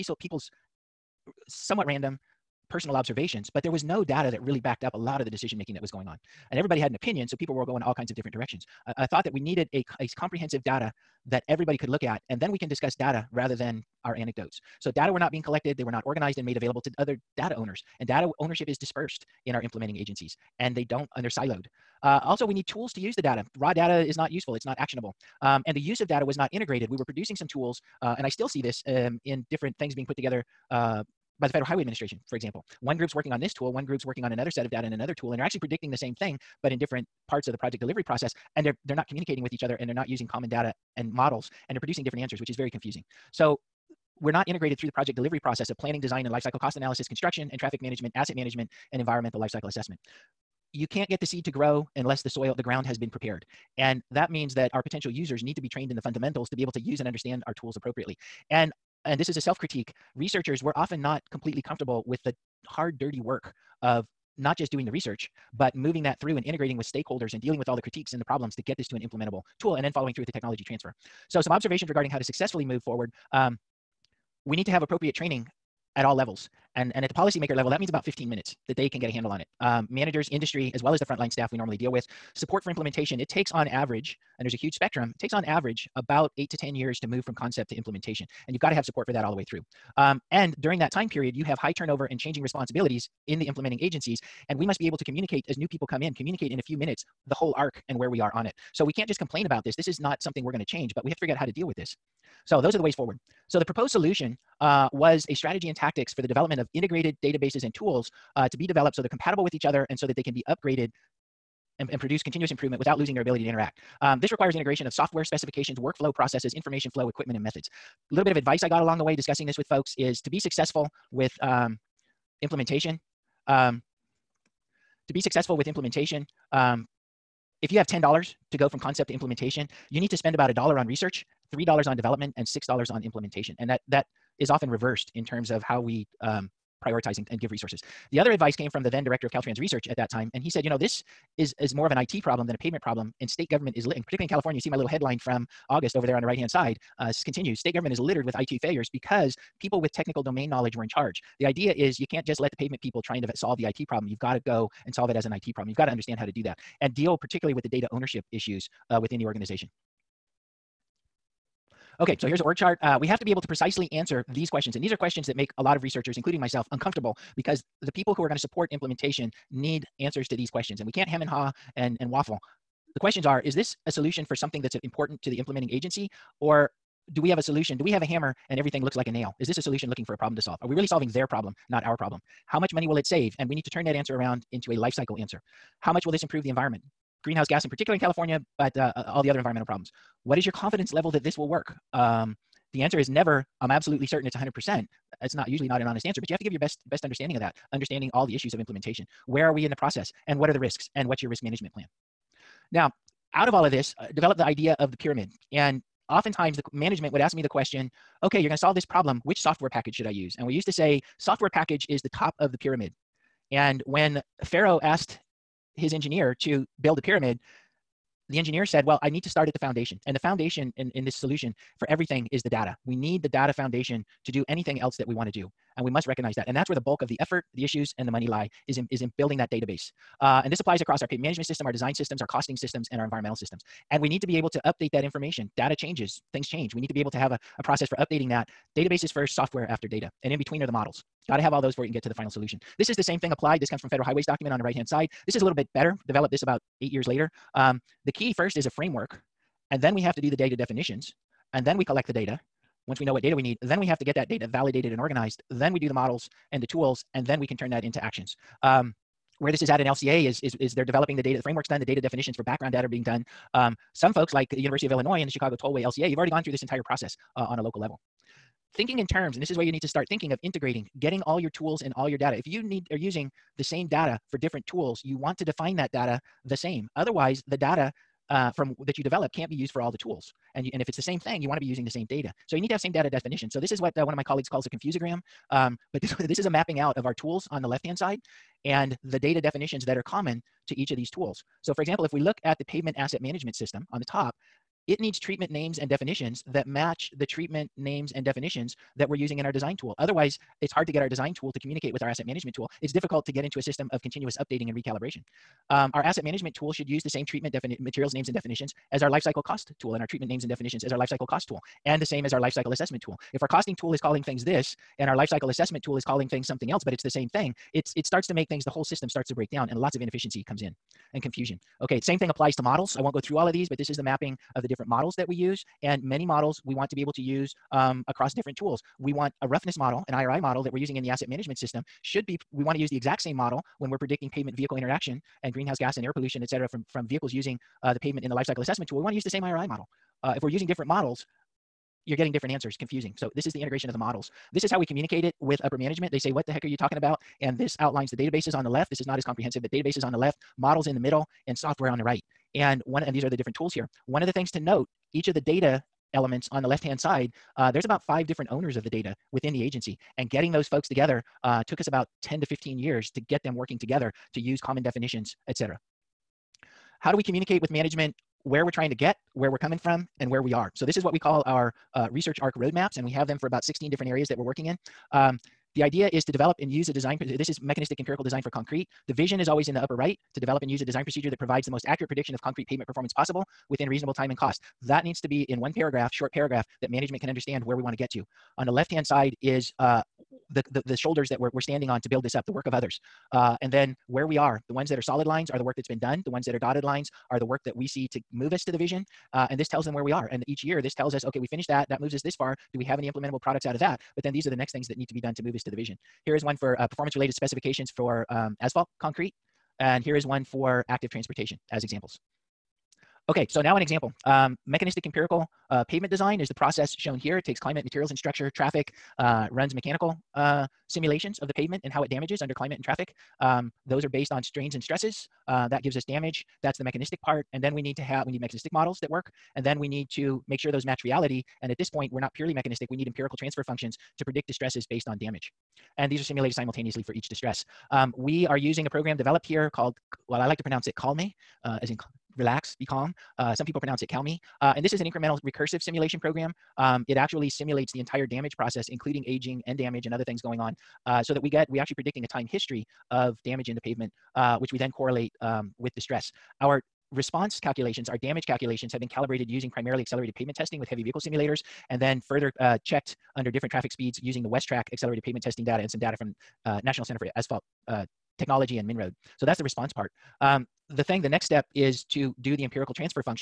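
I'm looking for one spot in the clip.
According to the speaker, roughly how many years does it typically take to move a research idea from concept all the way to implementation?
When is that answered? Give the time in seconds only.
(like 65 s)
86 s.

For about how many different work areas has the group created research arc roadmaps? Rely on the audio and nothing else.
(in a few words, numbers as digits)
16.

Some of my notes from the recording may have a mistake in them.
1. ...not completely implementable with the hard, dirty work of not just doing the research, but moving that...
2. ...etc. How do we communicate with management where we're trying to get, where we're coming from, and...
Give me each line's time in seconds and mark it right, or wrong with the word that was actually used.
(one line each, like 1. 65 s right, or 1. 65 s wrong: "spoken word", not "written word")
1. 61 s wrong: "comfortable", not "implementable"
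2. 365 s right.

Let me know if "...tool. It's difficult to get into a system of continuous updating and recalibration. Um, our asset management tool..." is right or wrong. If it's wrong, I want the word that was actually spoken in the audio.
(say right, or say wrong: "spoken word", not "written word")
right.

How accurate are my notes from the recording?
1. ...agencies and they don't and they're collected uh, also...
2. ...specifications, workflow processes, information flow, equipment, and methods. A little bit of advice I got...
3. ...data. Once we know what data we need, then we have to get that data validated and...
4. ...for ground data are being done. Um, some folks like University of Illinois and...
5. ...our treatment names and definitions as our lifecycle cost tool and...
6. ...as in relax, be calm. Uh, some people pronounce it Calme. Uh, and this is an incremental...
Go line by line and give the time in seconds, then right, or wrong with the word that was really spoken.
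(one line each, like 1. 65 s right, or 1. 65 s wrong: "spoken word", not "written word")
1. 19 s wrong: "siloed", not "collected"
2. 115 s right
3. 252 s right
4. 262 s wrong: "background", not "ground"
5. 310 s right
6. 441 s right.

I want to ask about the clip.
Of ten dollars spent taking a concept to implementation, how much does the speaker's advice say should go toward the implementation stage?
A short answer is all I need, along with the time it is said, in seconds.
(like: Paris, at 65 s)
$6, at 132 s.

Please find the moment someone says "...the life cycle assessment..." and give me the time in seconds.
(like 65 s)
338 s.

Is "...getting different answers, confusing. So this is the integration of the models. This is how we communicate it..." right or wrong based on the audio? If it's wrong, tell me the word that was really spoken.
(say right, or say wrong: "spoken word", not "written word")
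right.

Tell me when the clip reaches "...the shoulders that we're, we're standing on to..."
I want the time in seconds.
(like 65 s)
390 s.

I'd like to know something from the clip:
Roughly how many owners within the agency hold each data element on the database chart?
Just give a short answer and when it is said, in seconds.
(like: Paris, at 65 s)
5, at 358 s.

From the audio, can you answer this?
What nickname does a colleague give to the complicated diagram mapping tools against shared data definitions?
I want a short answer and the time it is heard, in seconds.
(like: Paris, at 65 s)
confusogram, at 284 s.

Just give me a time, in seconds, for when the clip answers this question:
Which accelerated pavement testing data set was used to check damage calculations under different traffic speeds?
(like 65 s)
464 s.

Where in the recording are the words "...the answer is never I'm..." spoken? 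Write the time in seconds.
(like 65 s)
192 s.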